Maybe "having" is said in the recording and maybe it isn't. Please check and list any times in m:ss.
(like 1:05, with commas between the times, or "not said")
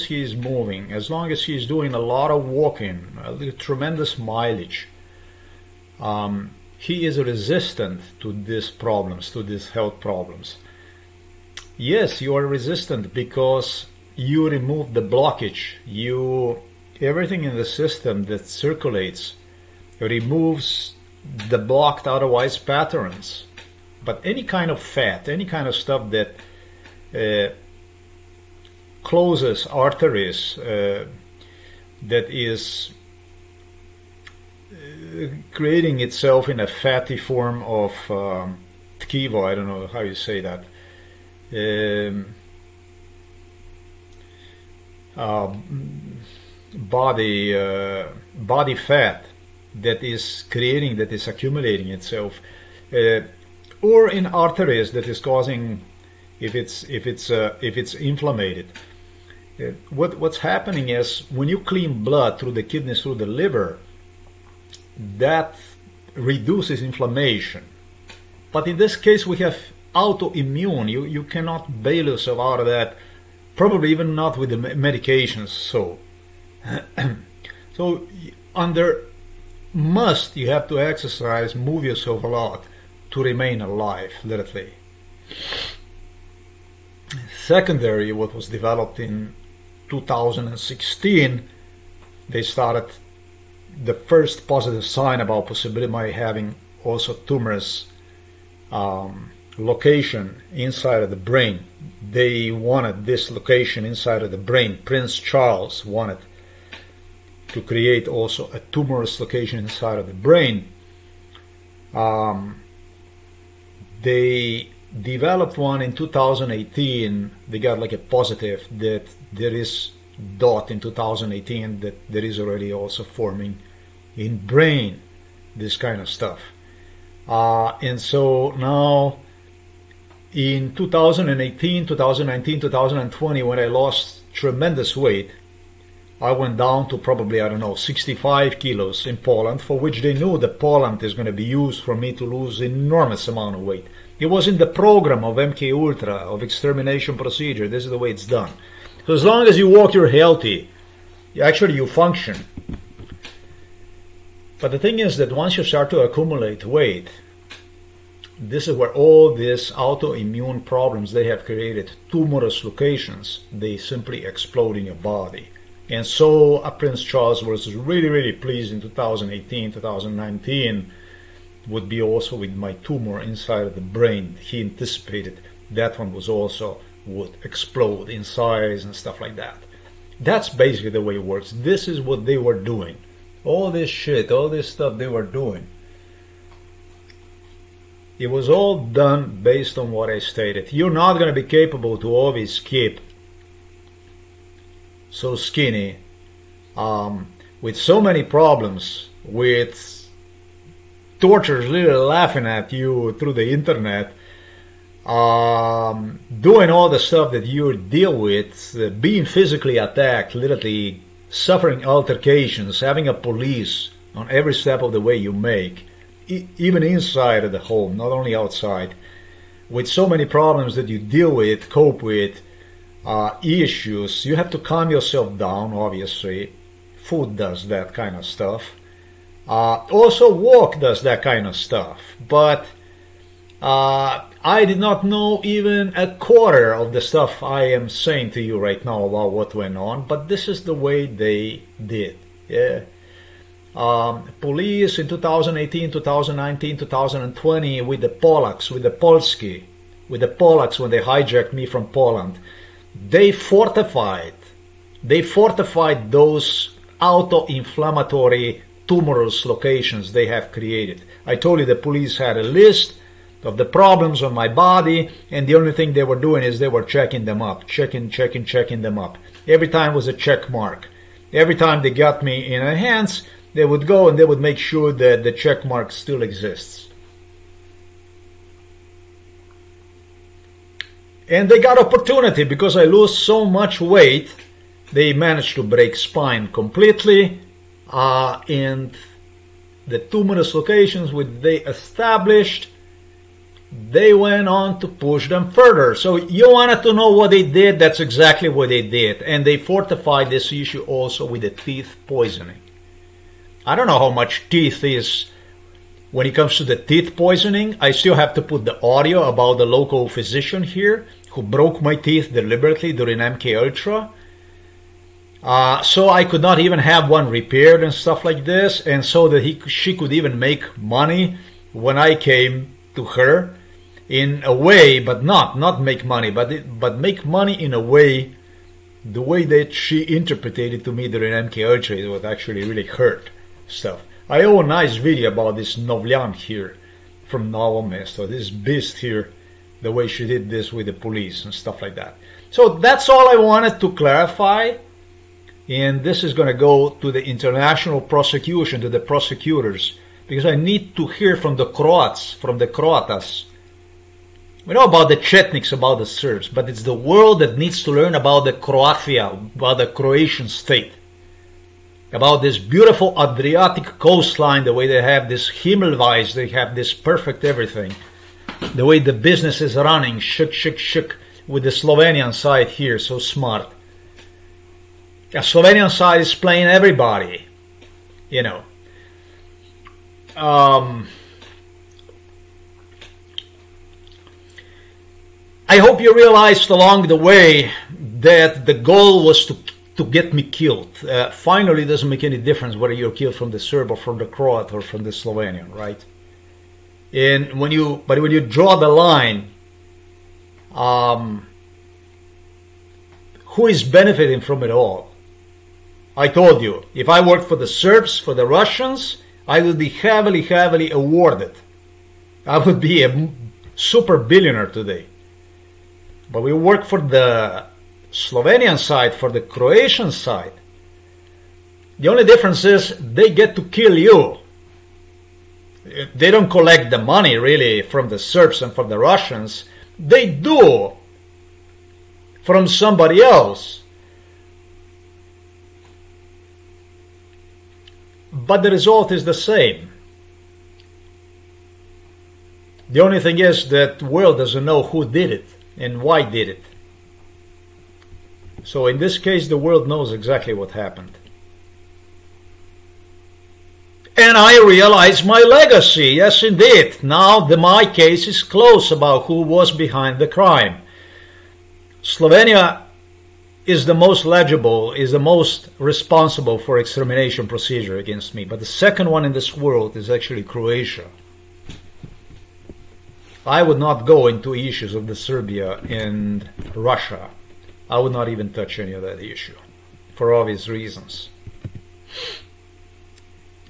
1:36, 3:32.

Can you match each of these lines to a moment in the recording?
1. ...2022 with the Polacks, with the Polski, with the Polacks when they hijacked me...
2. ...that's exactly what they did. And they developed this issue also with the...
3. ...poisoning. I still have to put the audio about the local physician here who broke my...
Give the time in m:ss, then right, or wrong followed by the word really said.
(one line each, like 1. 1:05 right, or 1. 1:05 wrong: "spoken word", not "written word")
1. 4:06 wrong: "2020", not "2022"
2. 4:57 wrong: "fortified", not "developed"
3. 5:07 right.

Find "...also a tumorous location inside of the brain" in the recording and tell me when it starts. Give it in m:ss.
1:48.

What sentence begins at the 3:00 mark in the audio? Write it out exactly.
That's basically the way it works.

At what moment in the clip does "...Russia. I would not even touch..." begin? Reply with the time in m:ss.
7:56.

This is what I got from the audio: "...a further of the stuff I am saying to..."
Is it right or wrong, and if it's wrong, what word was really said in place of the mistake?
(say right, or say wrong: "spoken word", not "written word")
wrong: "quarter", not "further".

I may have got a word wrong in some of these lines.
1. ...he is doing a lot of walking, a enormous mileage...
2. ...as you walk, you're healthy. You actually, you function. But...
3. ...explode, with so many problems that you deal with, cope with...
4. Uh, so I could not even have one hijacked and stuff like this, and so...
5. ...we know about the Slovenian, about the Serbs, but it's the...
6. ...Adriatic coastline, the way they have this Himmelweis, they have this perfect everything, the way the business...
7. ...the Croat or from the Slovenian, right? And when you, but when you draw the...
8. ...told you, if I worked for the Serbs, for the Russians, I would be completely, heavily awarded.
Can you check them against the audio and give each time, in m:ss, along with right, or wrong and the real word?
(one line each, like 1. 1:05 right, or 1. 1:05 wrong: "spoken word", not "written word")
1. 0:01 wrong: "tremendous", not "enormous"
2. 2:29 right
3. 3:38 wrong: "outside", not "explode"
4. 5:15 wrong: "repaired", not "hijacked"
5. 5:54 wrong: "Chetniks", not "Slovenian"
6. 6:03 right
7. 6:34 right
8. 6:46 wrong: "heavily", not "completely".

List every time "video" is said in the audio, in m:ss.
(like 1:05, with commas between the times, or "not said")
5:34.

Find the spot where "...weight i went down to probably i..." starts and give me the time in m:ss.
2:14.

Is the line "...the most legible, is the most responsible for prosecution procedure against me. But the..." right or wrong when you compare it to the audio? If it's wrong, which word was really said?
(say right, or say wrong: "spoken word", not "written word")
wrong: "extermination", not "prosecution".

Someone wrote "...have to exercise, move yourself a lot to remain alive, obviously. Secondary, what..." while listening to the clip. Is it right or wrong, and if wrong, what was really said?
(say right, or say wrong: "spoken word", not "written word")
wrong: "literally", not "obviously".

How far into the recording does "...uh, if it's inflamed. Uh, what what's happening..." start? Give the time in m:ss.
0:57.